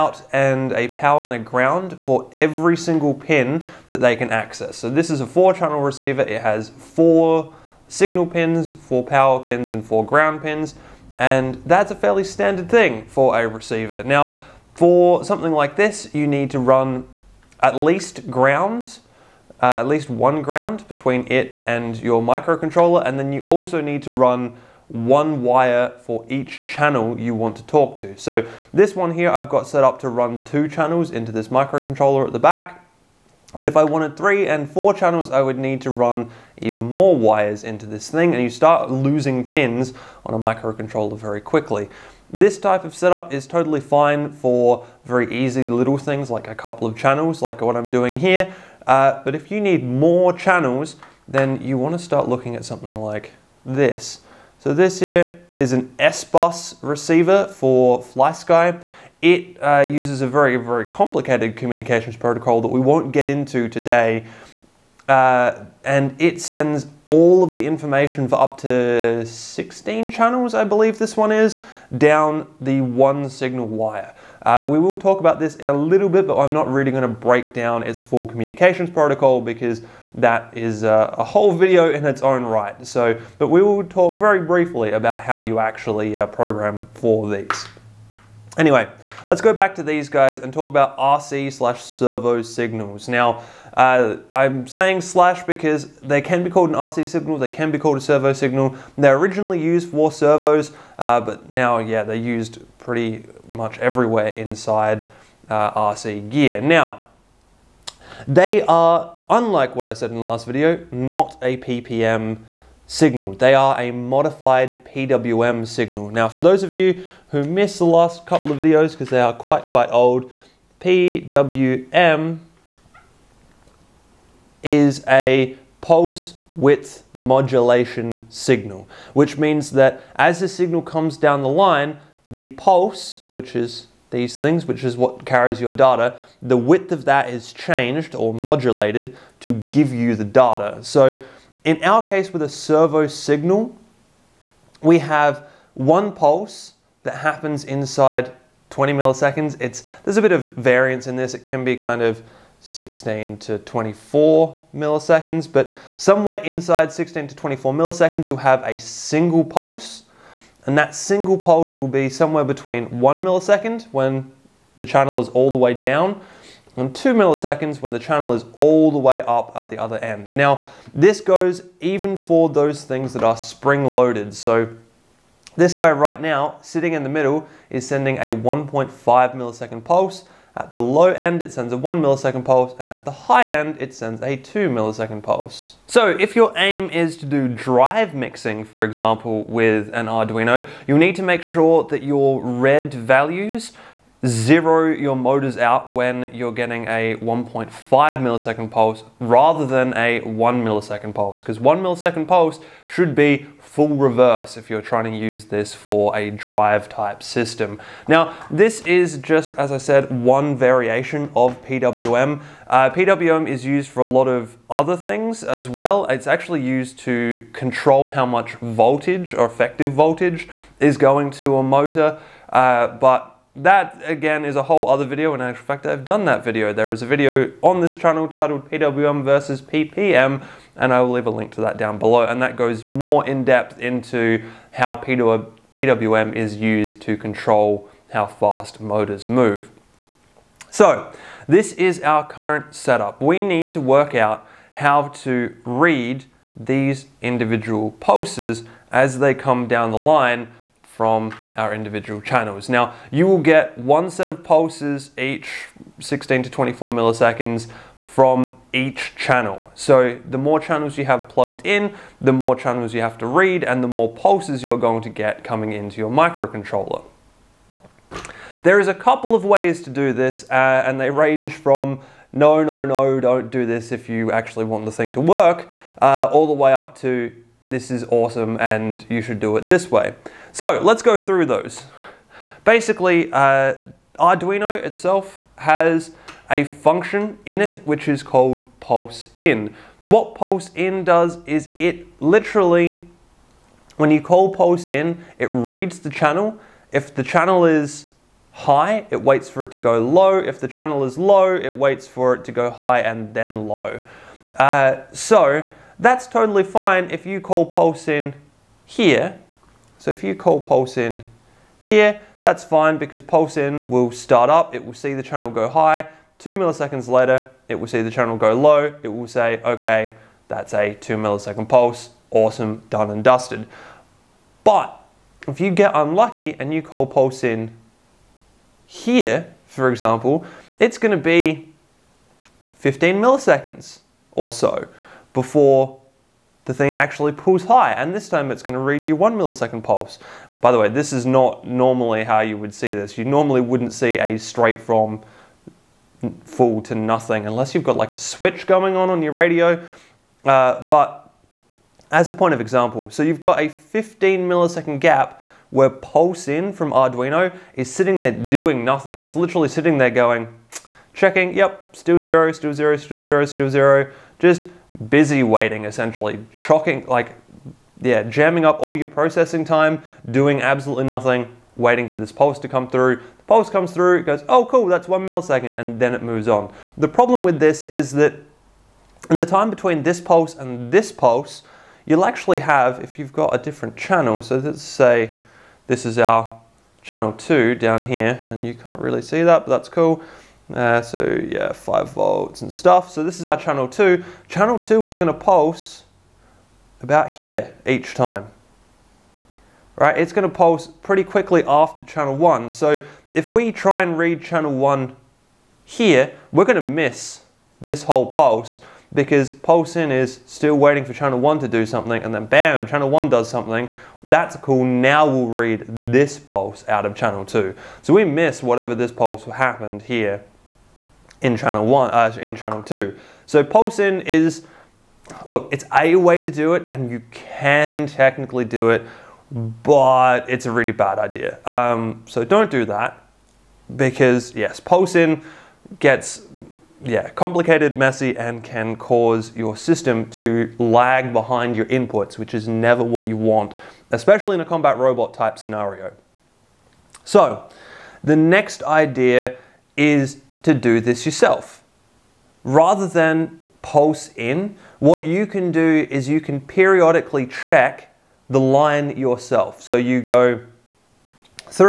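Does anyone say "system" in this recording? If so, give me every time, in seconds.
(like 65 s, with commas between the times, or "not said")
207 s, 439 s.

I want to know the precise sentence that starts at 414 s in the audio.
That's cool, now we'll read this pulse out of channel two.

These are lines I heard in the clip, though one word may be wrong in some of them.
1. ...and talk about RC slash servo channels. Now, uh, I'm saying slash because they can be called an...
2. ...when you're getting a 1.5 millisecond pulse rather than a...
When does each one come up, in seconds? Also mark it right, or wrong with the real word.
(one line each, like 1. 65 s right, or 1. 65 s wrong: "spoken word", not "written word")
1. 90 s wrong: "signals", not "channels"
2. 195 s right.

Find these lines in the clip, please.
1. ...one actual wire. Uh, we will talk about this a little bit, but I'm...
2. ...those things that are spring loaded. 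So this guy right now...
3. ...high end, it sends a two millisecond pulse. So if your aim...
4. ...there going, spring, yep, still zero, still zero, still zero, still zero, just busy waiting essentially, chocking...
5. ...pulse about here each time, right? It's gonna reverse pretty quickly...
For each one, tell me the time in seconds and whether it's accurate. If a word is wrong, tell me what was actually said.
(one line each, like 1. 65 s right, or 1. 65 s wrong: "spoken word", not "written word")
1. 72 s wrong: "signal", not "actual"
2. 172 s right
3. 183 s right
4. 359 s wrong: "checking", not "spring"
5. 395 s wrong: "pulse", not "reverse".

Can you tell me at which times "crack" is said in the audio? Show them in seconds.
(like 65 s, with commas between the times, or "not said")
not said.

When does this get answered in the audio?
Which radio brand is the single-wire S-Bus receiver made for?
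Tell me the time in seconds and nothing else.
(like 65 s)
58 s.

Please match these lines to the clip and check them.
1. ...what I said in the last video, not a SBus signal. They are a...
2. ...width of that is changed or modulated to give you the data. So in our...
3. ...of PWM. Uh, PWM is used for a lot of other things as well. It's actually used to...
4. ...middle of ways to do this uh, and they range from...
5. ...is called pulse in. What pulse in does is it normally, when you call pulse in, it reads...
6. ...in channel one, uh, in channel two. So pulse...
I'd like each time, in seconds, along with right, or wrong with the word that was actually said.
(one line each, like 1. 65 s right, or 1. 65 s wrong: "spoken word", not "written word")
1. 109 s wrong: "PPM", not "SBus"
2. 136 s right
3. 211 s right
4. 268 s wrong: "couple", not "middle"
5. 288 s wrong: "literally", not "normally"
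6. 421 s right.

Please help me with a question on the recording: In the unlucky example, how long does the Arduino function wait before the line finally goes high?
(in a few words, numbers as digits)
15 milliseconds.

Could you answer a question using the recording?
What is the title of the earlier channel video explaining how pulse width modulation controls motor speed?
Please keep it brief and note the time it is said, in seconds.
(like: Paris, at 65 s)
PWM versus PPM, at 228 s.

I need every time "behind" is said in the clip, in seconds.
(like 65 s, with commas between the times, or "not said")
441 s.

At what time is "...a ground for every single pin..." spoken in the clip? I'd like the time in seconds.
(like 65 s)
1 s.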